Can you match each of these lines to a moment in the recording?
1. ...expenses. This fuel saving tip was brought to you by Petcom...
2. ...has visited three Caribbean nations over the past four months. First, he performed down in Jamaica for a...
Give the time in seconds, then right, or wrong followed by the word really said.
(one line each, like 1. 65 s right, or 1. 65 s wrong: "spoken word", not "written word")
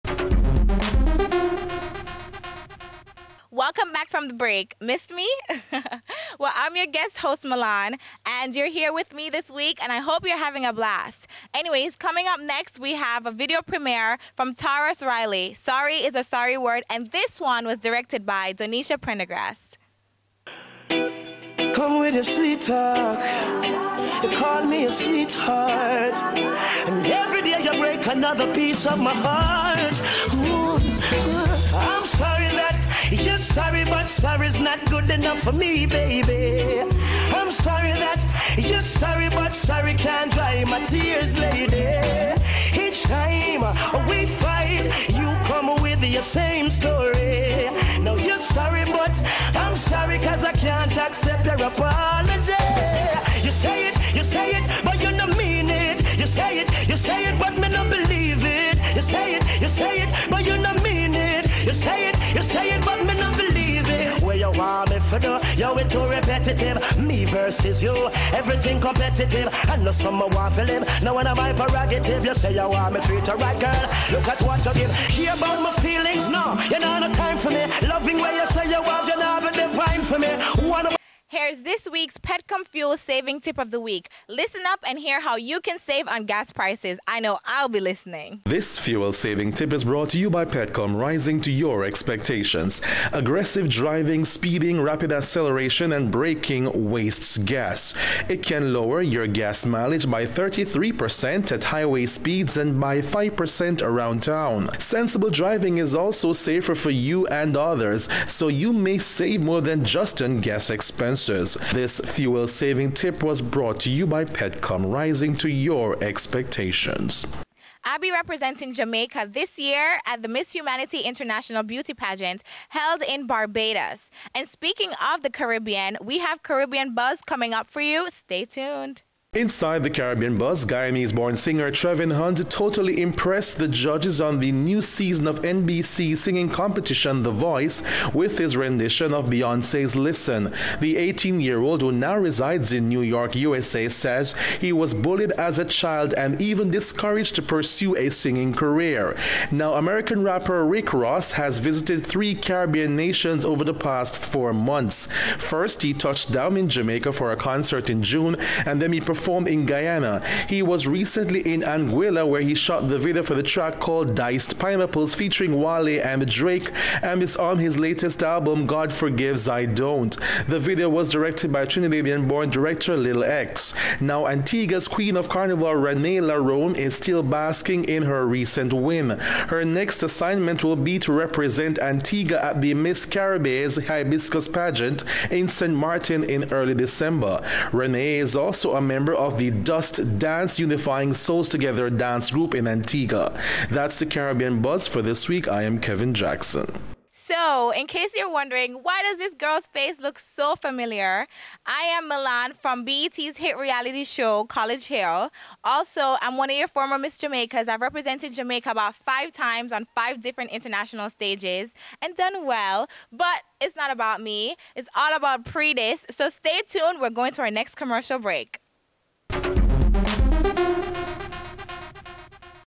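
1. 110 s right
2. 151 s wrong: "touched", not "performed".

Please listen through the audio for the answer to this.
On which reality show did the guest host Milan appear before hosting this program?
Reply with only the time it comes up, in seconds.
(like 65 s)
204 s.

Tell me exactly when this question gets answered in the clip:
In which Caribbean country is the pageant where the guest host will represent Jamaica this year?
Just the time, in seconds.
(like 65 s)
123 s.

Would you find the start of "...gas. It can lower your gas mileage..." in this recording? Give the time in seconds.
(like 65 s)
97 s.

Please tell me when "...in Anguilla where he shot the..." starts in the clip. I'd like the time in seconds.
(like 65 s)
161 s.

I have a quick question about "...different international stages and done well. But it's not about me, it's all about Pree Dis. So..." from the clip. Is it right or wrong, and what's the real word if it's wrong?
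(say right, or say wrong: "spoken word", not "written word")
right.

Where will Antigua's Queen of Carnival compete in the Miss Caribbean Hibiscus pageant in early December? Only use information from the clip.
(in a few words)
St. Martin.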